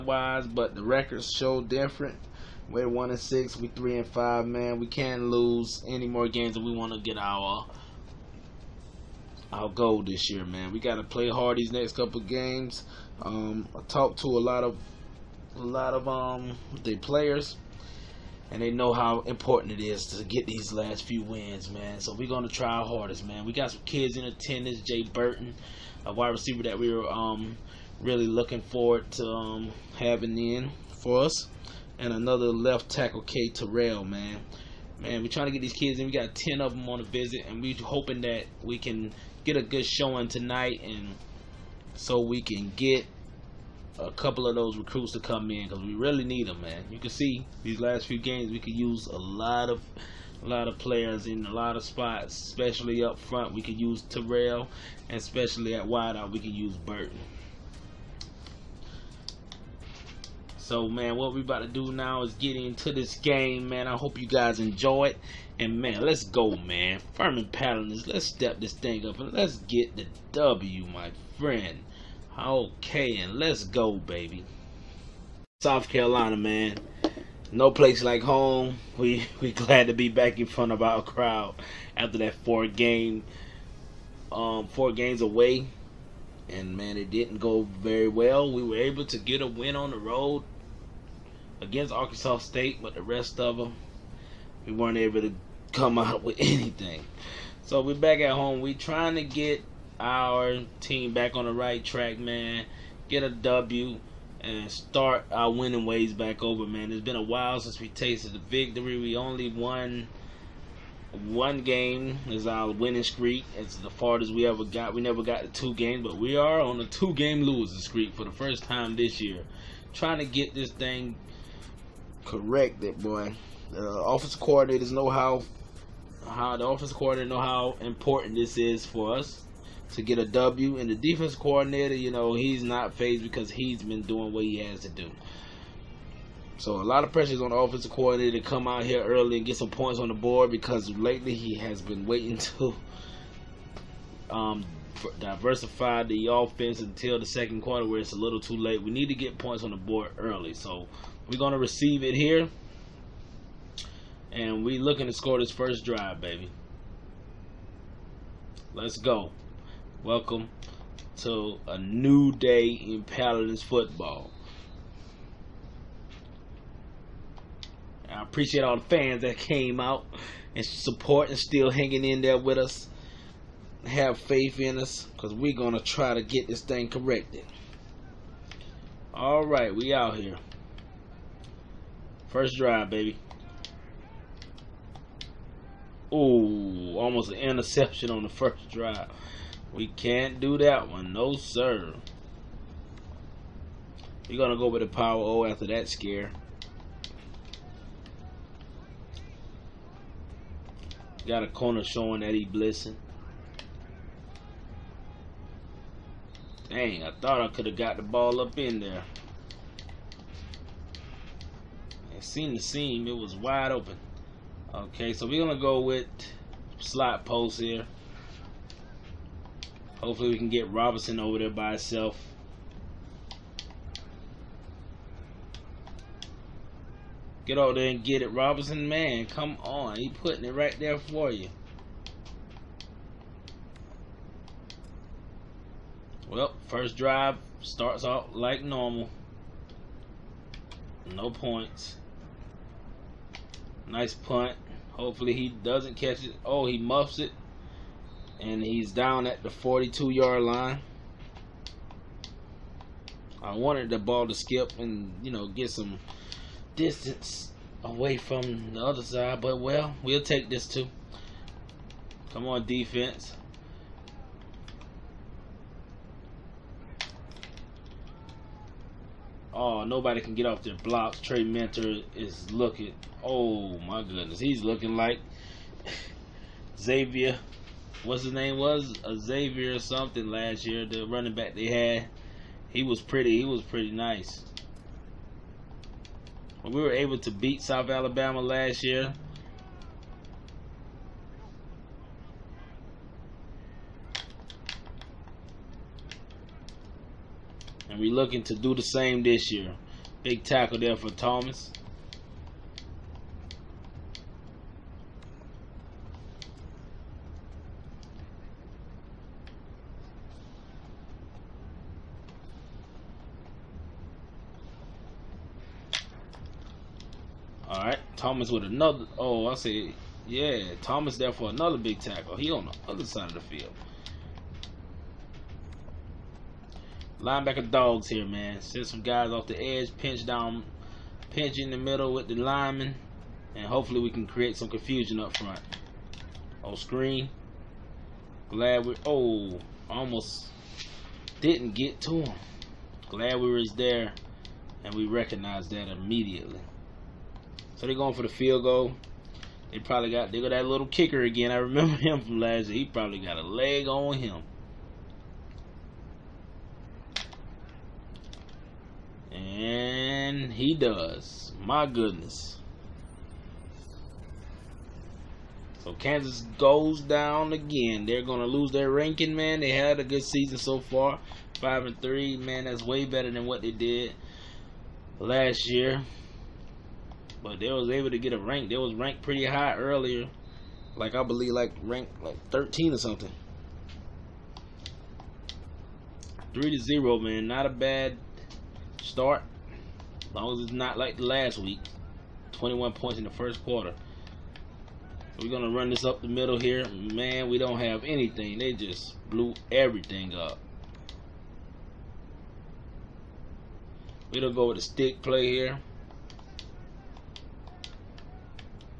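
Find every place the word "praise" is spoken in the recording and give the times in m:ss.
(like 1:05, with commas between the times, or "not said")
not said.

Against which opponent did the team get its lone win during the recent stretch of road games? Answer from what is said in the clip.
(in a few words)
Arkansas State.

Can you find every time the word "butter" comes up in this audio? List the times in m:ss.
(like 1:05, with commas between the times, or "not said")
not said.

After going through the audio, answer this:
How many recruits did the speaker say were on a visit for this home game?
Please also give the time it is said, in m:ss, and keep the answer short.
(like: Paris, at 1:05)
10, at 0:36.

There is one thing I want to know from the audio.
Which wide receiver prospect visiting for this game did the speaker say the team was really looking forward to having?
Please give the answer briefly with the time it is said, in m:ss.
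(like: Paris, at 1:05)
Jay Burton, at 0:24.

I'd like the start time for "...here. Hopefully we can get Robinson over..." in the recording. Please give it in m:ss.
3:37.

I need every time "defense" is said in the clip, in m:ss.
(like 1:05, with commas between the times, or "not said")
2:10, 4:22.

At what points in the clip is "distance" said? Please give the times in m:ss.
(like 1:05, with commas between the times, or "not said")
4:16.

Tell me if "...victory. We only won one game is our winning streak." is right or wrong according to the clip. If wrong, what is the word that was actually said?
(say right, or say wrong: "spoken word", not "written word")
right.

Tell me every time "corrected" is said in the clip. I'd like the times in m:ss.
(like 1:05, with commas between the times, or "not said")
2:02, 2:56.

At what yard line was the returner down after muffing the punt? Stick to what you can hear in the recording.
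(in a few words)
42.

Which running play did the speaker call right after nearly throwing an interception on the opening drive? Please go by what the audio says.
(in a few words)
Power O.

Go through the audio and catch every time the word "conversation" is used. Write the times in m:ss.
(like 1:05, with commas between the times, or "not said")
not said.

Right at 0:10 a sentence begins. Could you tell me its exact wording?
We got to play hard these next couple games.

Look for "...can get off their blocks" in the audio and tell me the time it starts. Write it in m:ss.
4:30.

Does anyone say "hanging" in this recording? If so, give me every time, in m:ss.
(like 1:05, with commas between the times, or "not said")
2:51.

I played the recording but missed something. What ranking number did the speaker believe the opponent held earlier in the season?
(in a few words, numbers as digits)
13.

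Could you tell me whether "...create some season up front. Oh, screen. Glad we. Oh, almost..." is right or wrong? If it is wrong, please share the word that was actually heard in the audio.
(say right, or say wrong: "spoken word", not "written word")
wrong: "confusion", not "season".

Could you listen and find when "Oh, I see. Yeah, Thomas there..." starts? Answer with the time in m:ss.
5:19.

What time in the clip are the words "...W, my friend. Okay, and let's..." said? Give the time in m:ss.
1:10.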